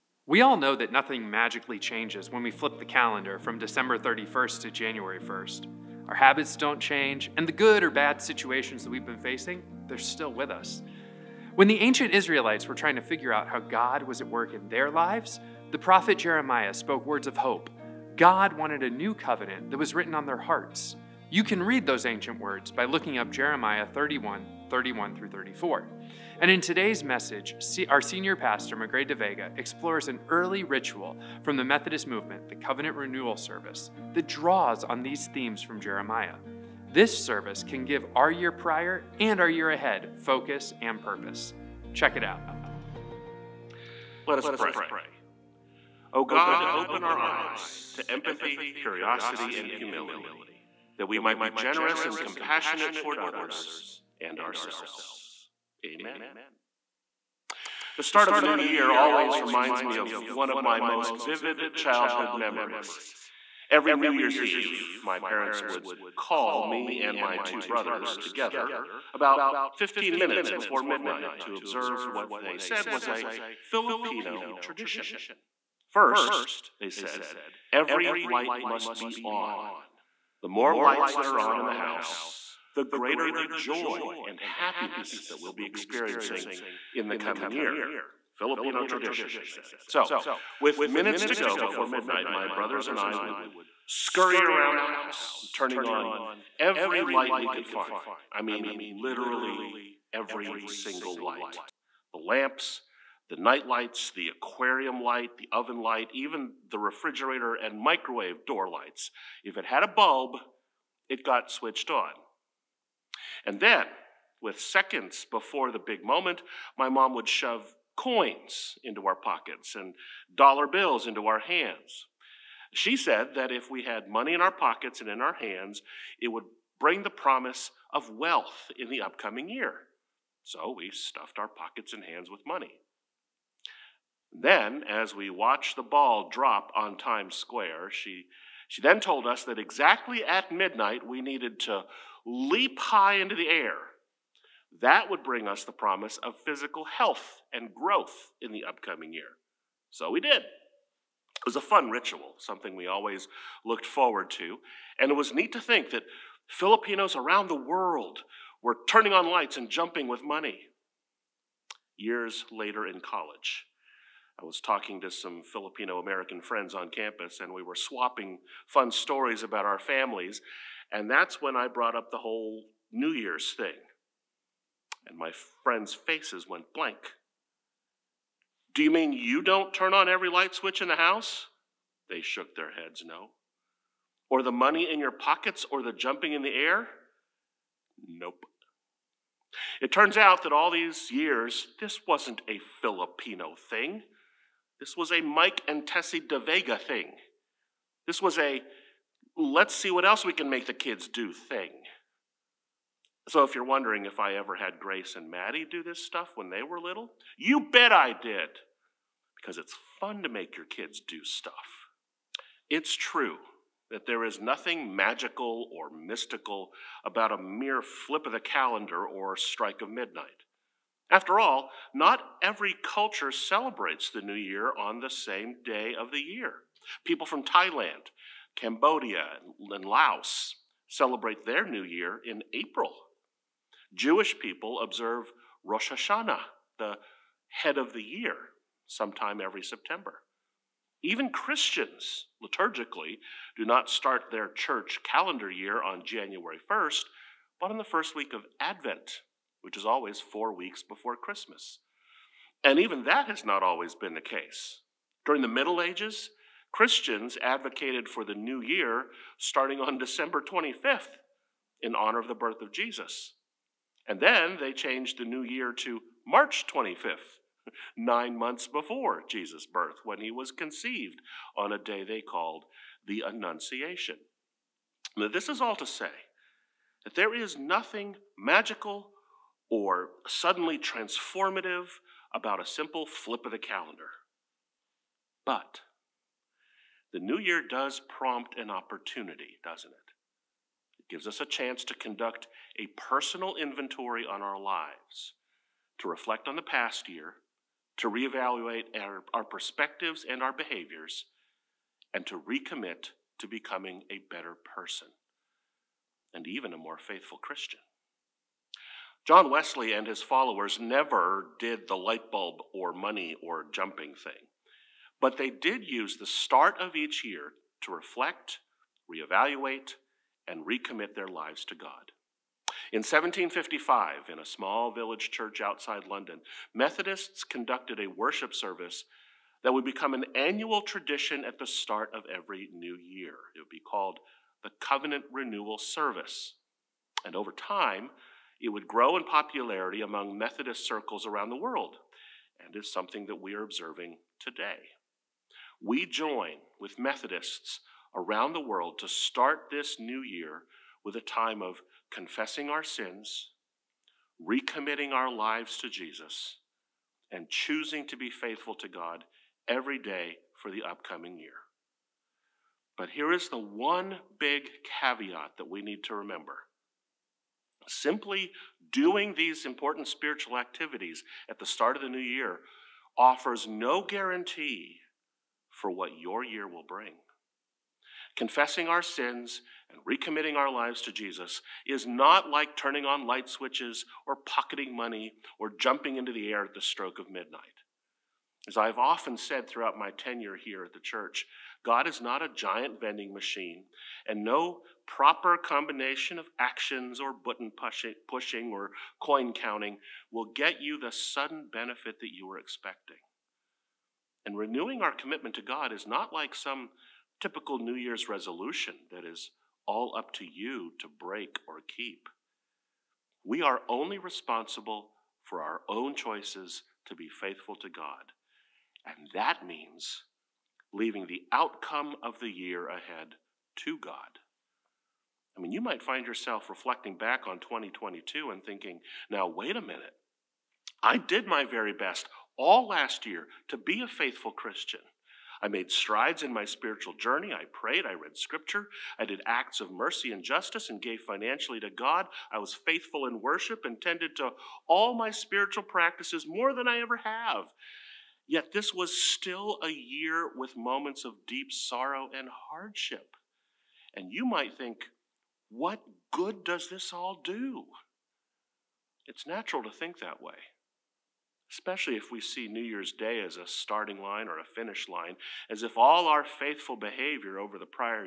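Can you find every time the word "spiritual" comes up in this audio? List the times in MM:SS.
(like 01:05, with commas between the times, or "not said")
06:10, 07:16, 07:25.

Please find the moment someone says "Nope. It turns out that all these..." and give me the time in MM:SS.
03:08.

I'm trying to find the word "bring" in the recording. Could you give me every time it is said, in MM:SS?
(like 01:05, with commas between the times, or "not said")
02:06, 02:25, 06:16.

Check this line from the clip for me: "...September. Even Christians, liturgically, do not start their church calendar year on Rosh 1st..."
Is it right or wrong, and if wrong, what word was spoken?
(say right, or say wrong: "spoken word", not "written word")
wrong: "January", not "Rosh".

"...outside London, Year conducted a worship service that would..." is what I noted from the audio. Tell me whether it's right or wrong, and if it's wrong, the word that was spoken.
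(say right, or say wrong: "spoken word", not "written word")
wrong: "Methodists", not "Year".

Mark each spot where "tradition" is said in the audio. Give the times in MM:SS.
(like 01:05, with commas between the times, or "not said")
01:14, 01:28, 05:30.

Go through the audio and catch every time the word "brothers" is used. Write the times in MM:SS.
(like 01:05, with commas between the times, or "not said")
01:07, 01:32.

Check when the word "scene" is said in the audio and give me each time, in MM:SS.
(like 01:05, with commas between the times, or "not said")
not said.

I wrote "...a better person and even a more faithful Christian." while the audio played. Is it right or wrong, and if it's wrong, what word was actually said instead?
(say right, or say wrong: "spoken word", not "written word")
right.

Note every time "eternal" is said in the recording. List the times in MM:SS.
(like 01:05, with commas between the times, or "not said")
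not said.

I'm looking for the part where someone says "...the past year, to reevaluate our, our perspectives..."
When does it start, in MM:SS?
04:56.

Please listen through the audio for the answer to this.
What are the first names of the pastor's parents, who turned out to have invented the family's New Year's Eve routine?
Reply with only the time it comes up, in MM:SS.
03:15.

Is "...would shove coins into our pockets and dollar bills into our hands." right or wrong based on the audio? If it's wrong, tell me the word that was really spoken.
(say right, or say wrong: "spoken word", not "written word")
right.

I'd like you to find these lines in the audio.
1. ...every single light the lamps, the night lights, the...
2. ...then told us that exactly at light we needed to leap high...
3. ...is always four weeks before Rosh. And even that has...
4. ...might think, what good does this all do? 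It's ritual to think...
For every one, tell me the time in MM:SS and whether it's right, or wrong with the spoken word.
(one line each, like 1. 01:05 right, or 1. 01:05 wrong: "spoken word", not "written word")
1. 01:40 right
2. 02:18 wrong: "midnight", not "light"
3. 04:09 wrong: "Christmas", not "Rosh"
4. 07:34 wrong: "natural", not "ritual".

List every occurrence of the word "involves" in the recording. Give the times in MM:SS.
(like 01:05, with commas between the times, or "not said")
not said.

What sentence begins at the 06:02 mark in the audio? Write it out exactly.
But here is the one big caveat that we need to remember.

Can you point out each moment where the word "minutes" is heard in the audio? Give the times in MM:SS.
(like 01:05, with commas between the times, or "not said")
01:10, 01:30, 07:09.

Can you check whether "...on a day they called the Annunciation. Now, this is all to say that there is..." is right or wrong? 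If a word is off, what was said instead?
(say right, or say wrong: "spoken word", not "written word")
right.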